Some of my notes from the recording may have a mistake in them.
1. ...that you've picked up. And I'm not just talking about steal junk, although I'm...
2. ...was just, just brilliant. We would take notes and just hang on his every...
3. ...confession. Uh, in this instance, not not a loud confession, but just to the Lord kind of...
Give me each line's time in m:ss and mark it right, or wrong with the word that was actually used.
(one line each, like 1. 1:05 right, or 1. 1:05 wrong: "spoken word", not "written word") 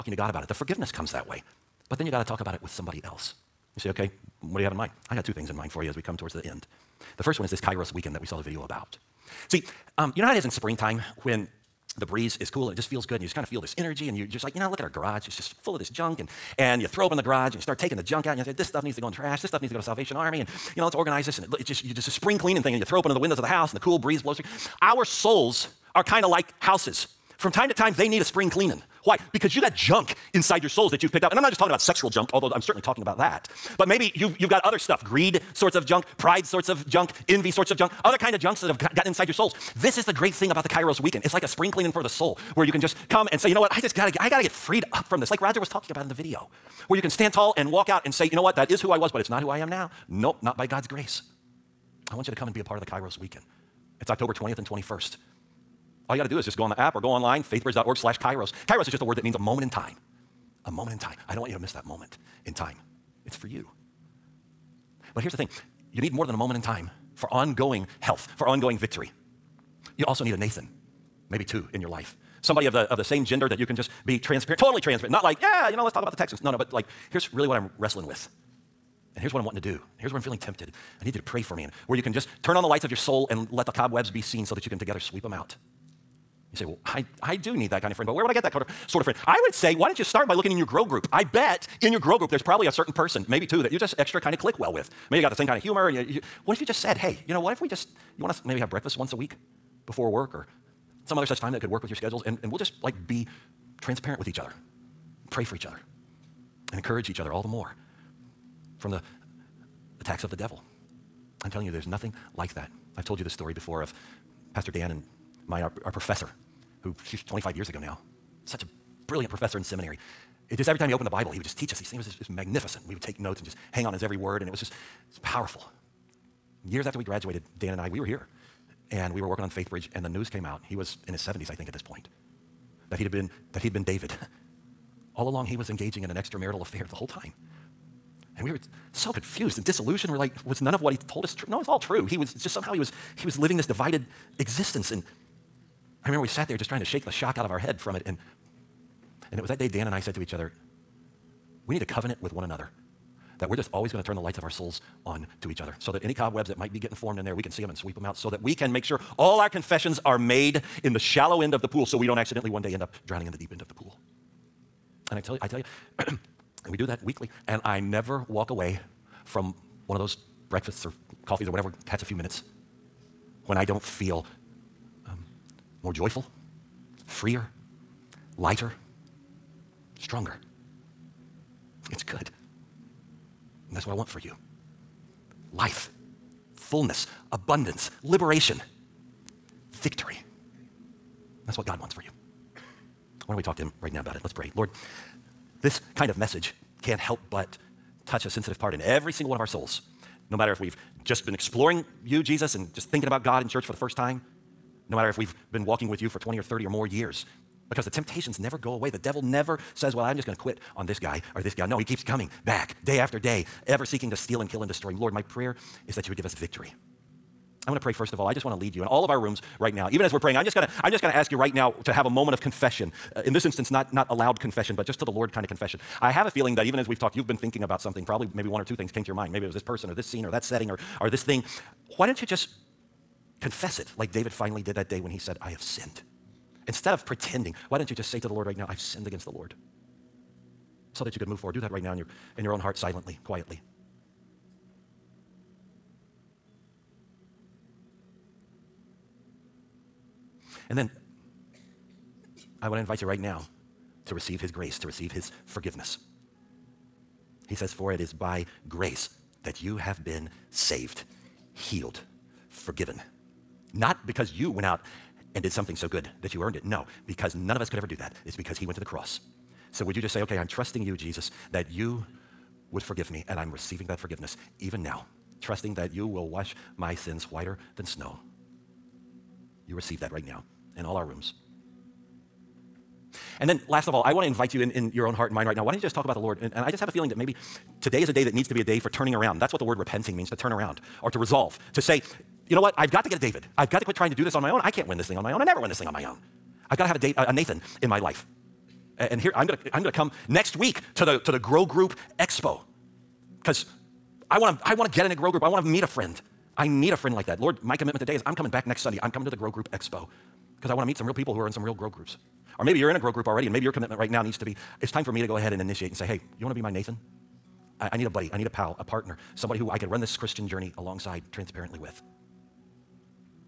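1. 0:30 wrong: "sexual", not "steal"
2. 2:01 wrong: "magnificent", not "brilliant"
3. 3:42 right.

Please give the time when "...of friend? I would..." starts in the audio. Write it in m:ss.
1:29.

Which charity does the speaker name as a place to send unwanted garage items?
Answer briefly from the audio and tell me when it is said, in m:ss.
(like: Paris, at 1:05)
Salvation Army, at 0:19.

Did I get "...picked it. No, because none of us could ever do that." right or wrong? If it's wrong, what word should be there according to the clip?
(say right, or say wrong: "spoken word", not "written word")
wrong: "earned", not "picked".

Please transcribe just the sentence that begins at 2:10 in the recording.
He was in his 70s, I think, at this point that he'd been, that he'd been David.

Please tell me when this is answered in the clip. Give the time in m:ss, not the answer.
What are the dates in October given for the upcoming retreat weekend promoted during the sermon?
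0:54.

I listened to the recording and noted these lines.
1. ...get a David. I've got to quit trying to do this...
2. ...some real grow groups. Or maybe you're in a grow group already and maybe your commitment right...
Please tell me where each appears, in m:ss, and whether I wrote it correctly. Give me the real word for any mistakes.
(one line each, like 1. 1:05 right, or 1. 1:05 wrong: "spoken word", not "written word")
1. 4:53 right
2. 5:11 right.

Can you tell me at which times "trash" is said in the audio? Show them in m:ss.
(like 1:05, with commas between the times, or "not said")
0:19.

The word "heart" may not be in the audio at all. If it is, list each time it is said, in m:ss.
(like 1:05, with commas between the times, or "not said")
4:02, 4:45.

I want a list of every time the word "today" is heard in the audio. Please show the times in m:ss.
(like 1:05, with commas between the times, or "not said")
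4:47, 5:07.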